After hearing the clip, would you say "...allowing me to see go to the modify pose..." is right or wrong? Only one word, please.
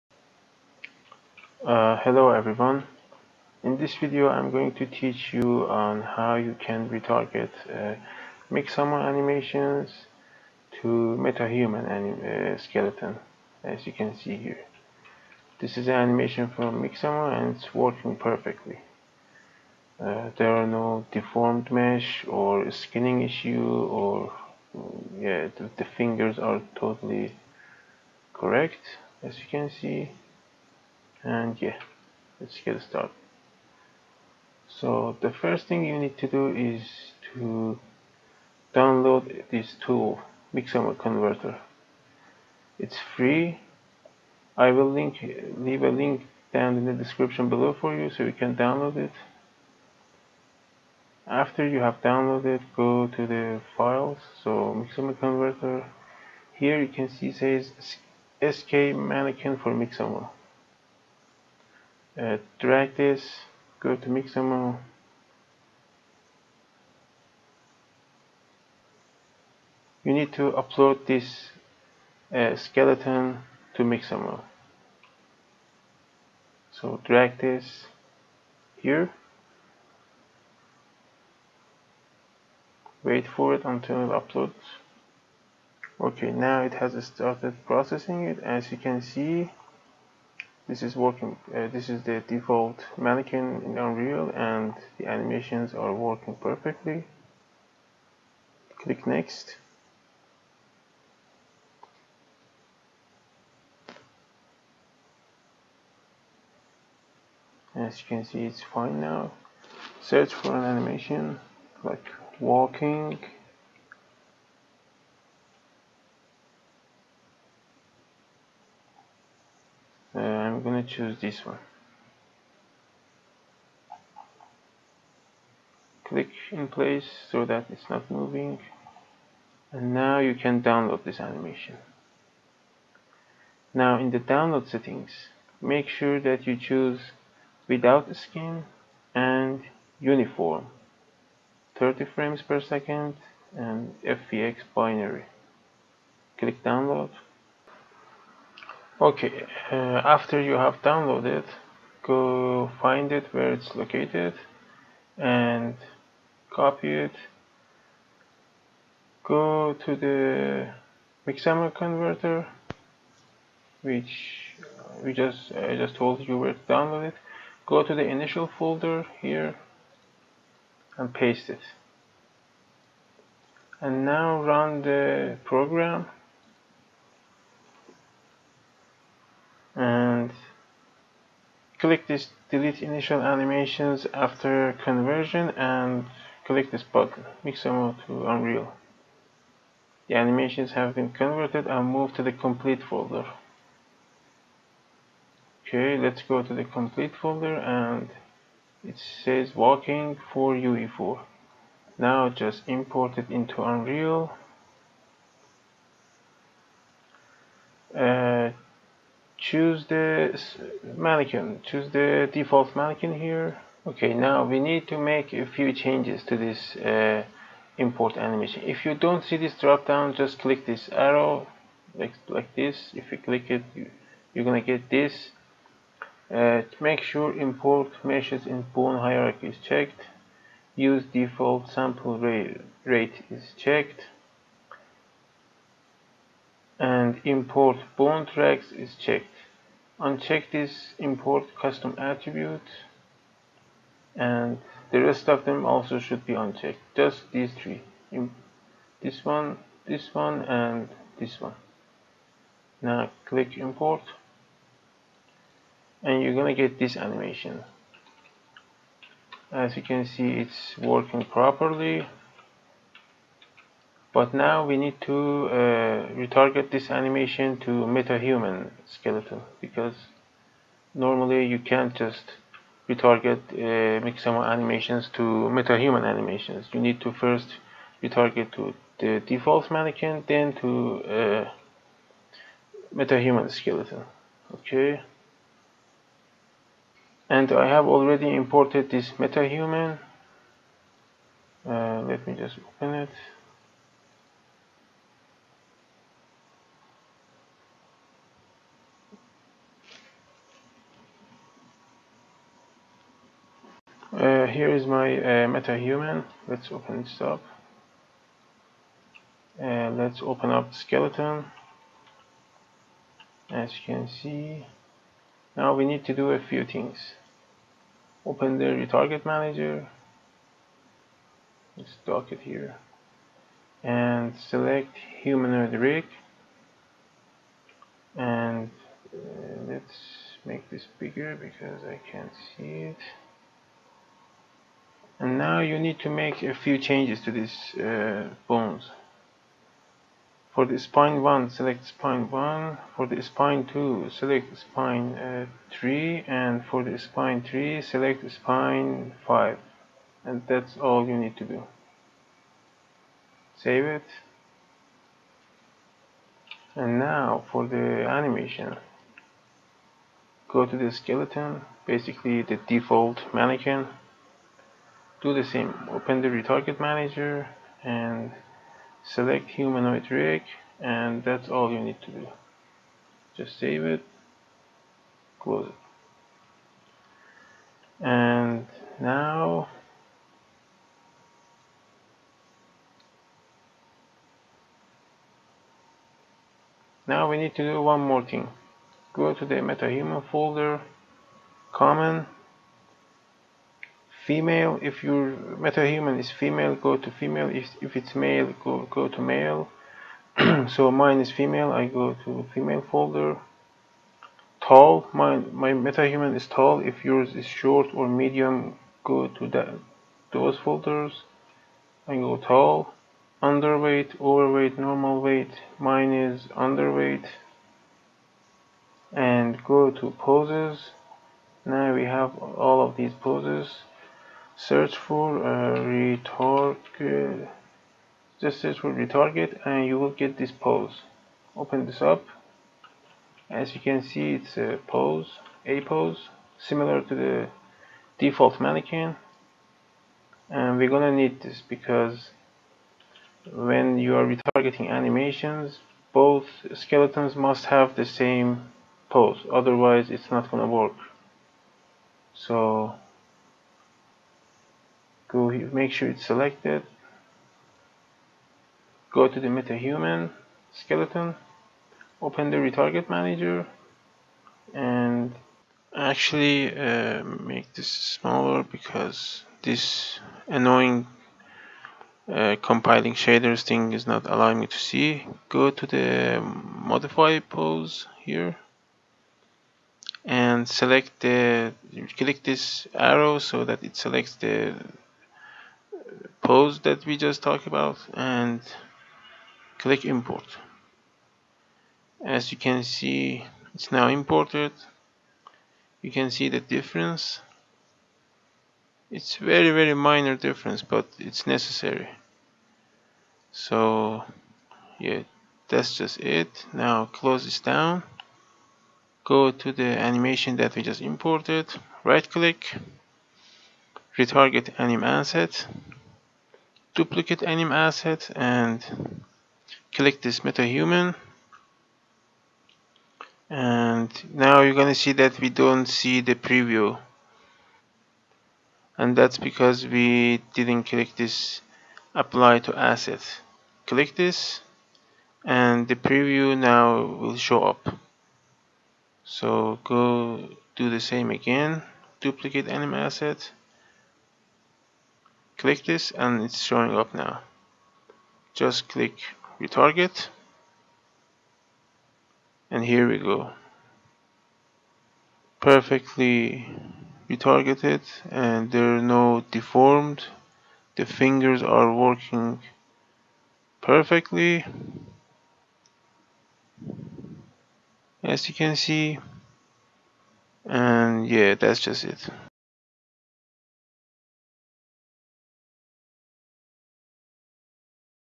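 right.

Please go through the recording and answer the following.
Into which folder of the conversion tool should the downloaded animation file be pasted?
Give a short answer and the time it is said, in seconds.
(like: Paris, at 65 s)
initial folder, at 168 s.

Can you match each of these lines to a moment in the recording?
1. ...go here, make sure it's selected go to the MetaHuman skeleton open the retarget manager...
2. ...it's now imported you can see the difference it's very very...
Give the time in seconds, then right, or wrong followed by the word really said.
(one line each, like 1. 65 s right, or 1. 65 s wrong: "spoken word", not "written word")
1. 455 s right
2. 493 s right.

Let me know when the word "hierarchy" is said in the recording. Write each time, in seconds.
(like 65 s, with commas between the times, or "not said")
228 s.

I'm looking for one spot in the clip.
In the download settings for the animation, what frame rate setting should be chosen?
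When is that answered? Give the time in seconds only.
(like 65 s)
139 s.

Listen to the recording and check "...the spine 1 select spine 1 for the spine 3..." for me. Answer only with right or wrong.
wrong.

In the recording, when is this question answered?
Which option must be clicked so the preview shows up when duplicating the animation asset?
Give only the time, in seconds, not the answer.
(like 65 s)
532 s.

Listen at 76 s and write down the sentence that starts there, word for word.
So drag this here, wait for it until it uploads.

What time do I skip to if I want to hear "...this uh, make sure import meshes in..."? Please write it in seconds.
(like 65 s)
224 s.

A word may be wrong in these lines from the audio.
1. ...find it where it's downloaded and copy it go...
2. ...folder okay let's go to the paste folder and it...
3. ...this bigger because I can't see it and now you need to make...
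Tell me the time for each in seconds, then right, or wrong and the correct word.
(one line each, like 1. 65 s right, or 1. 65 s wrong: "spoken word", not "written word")
1. 152 s wrong: "located", not "downloaded"
2. 192 s wrong: "complete", not "paste"
3. 330 s right.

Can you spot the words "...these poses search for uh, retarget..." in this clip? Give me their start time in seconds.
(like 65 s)
422 s.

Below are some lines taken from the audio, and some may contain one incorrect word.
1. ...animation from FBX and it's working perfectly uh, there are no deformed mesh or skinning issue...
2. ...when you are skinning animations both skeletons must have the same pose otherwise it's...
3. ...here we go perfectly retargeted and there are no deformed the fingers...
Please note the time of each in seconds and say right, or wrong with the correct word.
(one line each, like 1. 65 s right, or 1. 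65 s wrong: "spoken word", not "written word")
1. 15 s wrong: "Mixamo", not "FBX"
2. 443 s wrong: "retargeting", not "skinning"
3. 552 s right.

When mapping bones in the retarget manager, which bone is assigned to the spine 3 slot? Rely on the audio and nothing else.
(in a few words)
spine 5.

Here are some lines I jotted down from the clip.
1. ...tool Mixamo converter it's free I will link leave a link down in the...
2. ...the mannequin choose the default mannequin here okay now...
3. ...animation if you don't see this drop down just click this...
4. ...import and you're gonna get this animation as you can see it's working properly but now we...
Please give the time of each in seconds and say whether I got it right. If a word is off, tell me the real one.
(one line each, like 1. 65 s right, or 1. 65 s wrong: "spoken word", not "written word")
1. 39 s right
2. 209 s right
3. 218 s right
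4. 253 s right.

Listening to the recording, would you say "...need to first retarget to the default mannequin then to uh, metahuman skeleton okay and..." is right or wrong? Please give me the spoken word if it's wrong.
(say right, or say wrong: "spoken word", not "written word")
right.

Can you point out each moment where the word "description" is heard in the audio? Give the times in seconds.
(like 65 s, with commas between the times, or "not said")
46 s.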